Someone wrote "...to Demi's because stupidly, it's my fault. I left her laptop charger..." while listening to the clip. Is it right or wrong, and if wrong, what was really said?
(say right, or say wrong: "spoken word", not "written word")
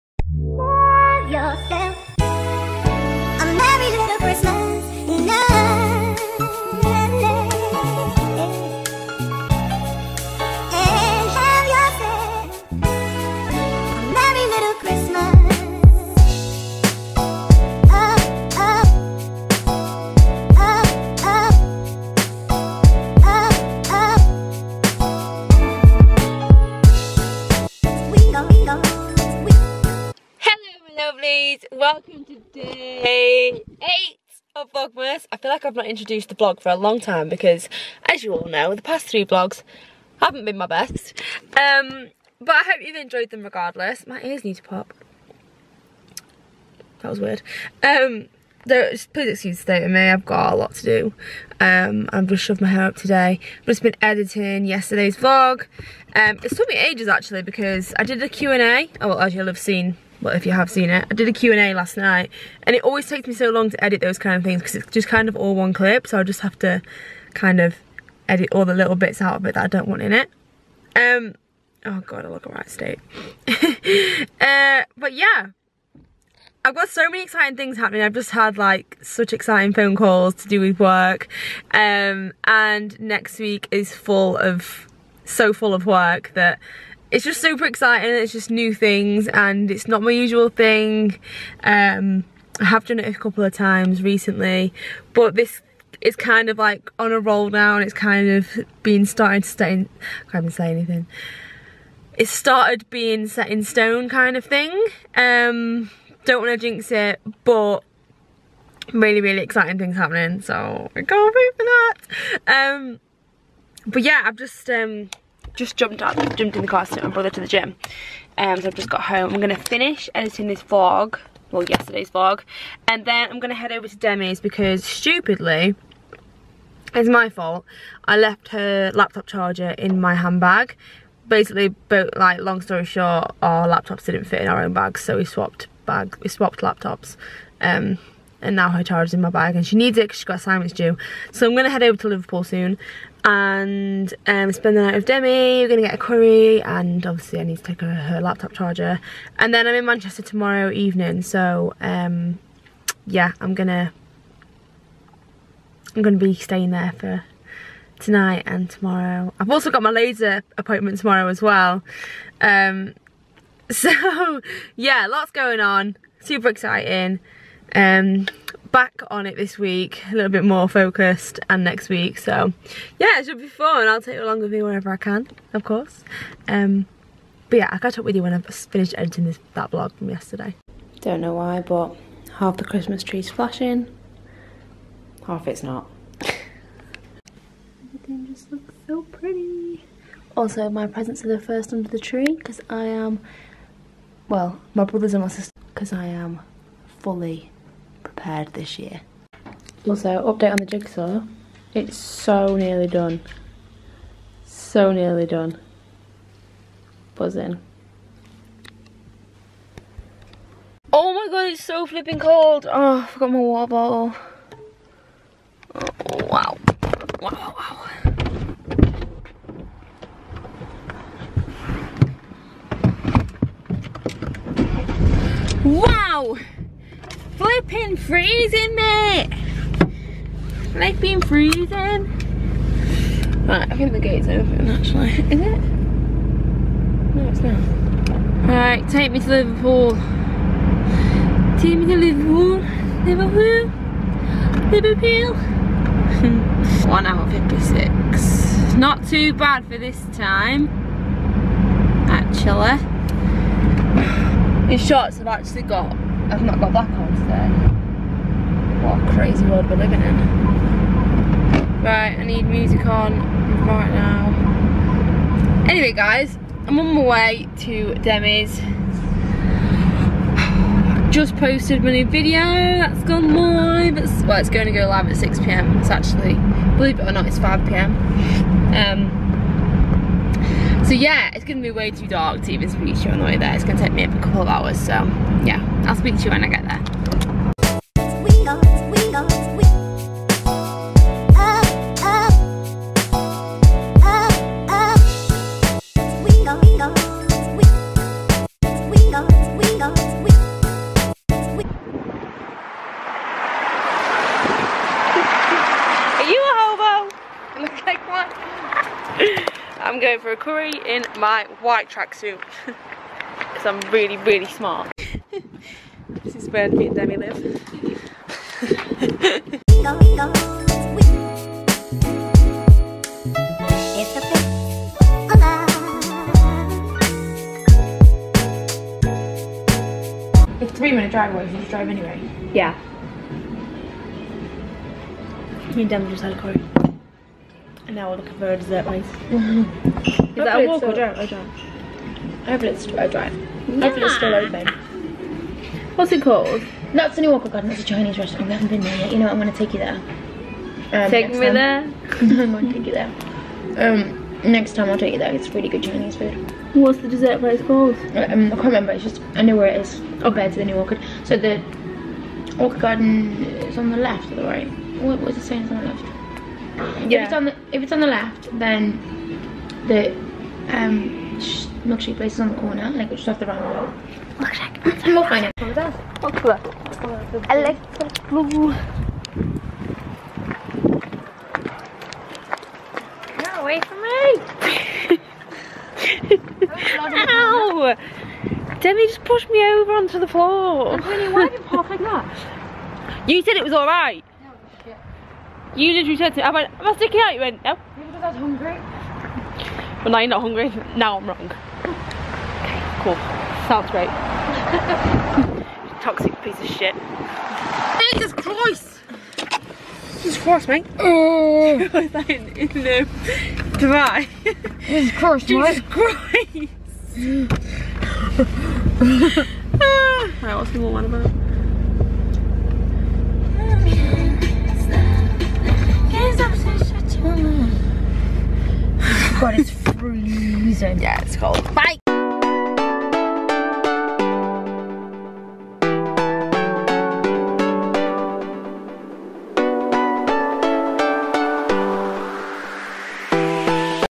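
right.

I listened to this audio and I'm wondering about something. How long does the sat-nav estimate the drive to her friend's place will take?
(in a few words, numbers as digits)
1 hour 56.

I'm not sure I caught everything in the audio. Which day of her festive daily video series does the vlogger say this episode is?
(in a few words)
Day 8.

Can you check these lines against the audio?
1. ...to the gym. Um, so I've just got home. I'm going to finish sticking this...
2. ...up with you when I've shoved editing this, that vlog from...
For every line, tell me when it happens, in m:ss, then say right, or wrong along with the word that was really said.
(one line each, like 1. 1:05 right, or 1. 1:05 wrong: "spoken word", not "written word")
1. 1:57 wrong: "editing", not "sticking"
2. 2:57 wrong: "finished", not "shoved".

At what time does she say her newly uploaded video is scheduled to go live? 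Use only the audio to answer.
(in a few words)
6pm.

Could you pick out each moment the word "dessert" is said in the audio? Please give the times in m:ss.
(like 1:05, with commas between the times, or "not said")
5:38, 5:57.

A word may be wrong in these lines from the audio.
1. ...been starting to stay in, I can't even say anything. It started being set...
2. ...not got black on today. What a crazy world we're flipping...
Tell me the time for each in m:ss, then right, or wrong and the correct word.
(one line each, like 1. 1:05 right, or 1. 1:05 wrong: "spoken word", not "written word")
1. 1:38 right
2. 4:16 wrong: "living", not "flipping".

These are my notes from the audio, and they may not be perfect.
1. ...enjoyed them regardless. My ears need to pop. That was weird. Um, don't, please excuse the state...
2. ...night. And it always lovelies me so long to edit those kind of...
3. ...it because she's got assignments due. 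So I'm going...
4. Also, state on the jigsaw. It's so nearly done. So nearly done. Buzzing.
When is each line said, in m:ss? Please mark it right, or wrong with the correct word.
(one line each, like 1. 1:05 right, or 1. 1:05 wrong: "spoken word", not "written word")
1. 0:42 right
2. 1:01 wrong: "takes", not "lovelies"
3. 2:19 right
4. 3:19 wrong: "update", not "state".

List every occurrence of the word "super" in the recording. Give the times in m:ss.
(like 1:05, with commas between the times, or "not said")
1:27, 2:46.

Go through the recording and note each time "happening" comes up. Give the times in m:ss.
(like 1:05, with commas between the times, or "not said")
1:17, 1:49.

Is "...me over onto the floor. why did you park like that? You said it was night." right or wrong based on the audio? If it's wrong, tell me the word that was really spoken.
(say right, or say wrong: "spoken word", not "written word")
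wrong: "alright", not "night".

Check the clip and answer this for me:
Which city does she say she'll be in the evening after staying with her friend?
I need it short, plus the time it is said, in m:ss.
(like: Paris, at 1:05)
Manchester, at 2:29.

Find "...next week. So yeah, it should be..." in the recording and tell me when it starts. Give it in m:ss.
2:51.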